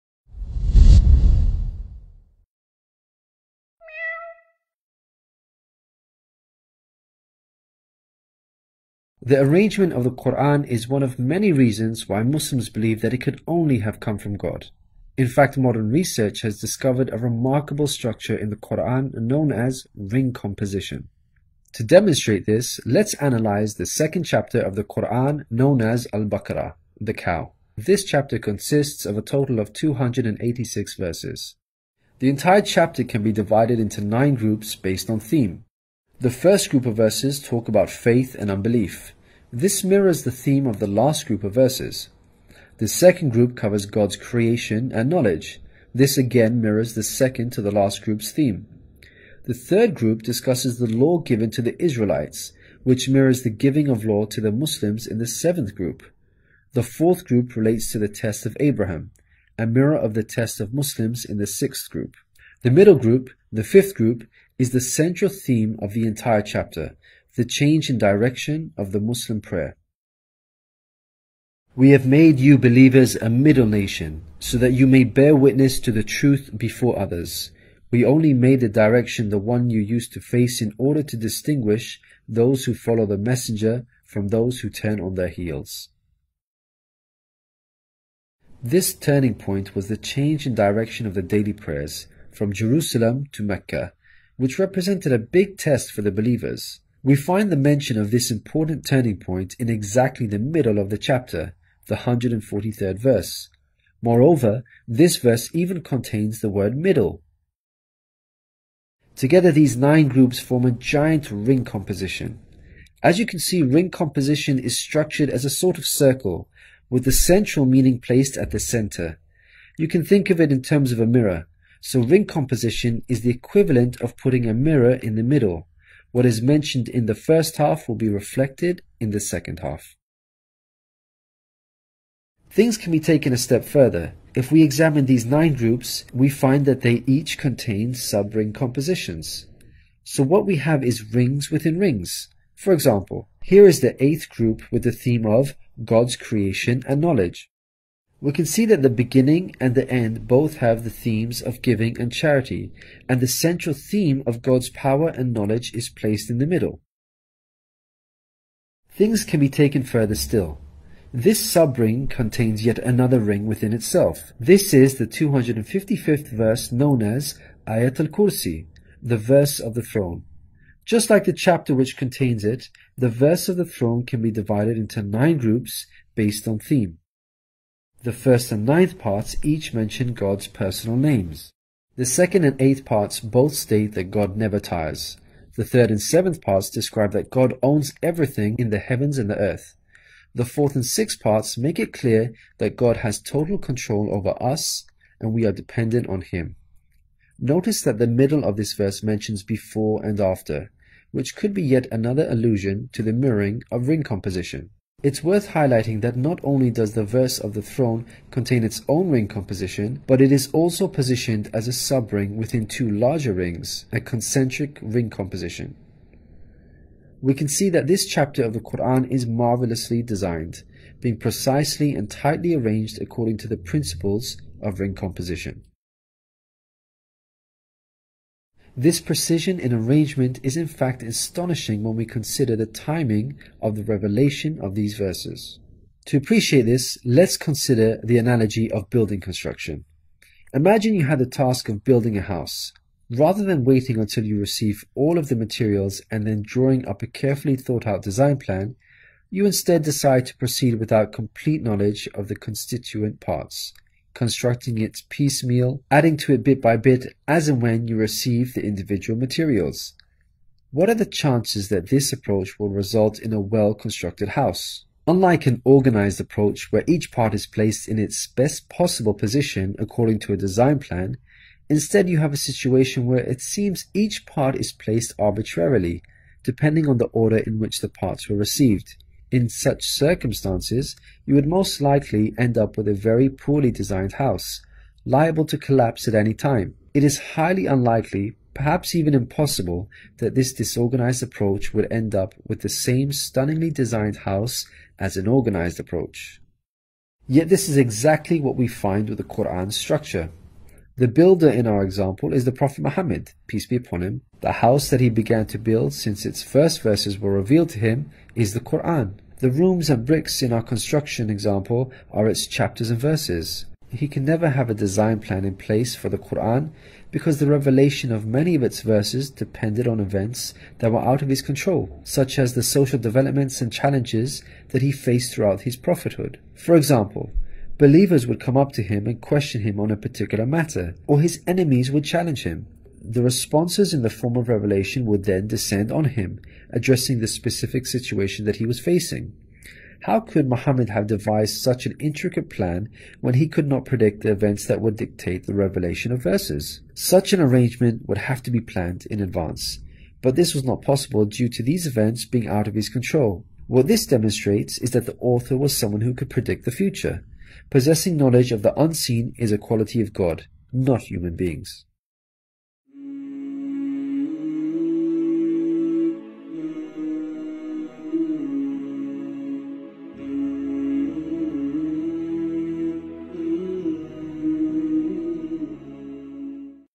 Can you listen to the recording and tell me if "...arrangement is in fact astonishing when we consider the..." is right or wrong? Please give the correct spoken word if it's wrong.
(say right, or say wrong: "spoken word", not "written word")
right.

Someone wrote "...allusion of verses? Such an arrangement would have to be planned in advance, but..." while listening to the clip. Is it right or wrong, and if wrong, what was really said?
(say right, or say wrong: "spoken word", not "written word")
wrong: "revelation", not "allusion".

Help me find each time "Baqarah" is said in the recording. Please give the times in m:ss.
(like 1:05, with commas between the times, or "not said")
0:26.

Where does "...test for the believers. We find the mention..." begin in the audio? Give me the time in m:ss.
1:35.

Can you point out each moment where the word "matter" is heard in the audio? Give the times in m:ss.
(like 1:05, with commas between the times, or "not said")
5:30.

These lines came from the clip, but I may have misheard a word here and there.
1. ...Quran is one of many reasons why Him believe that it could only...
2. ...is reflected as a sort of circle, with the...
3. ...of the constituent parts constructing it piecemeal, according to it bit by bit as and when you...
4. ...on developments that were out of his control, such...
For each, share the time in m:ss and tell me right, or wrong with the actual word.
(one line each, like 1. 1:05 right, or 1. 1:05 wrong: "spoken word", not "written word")
1. 0:10 wrong: "Muslims", not "Him"
2. 1:54 wrong: "structured", not "reflected"
3. 4:12 wrong: "adding", not "according"
4. 5:19 wrong: "events", not "developments".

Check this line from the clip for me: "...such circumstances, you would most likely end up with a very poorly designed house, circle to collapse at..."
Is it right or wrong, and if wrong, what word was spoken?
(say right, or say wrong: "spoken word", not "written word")
wrong: "liable", not "circle".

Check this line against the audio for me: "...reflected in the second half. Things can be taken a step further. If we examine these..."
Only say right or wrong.
right.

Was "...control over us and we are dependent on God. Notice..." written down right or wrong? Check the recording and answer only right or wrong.
wrong.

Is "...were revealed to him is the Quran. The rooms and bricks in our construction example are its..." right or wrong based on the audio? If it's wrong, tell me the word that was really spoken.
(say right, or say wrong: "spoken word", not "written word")
right.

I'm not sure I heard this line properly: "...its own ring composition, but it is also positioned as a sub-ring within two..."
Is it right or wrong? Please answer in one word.
right.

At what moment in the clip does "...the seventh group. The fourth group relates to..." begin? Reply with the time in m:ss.
0:55.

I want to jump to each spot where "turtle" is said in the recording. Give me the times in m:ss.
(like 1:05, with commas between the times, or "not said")
not said.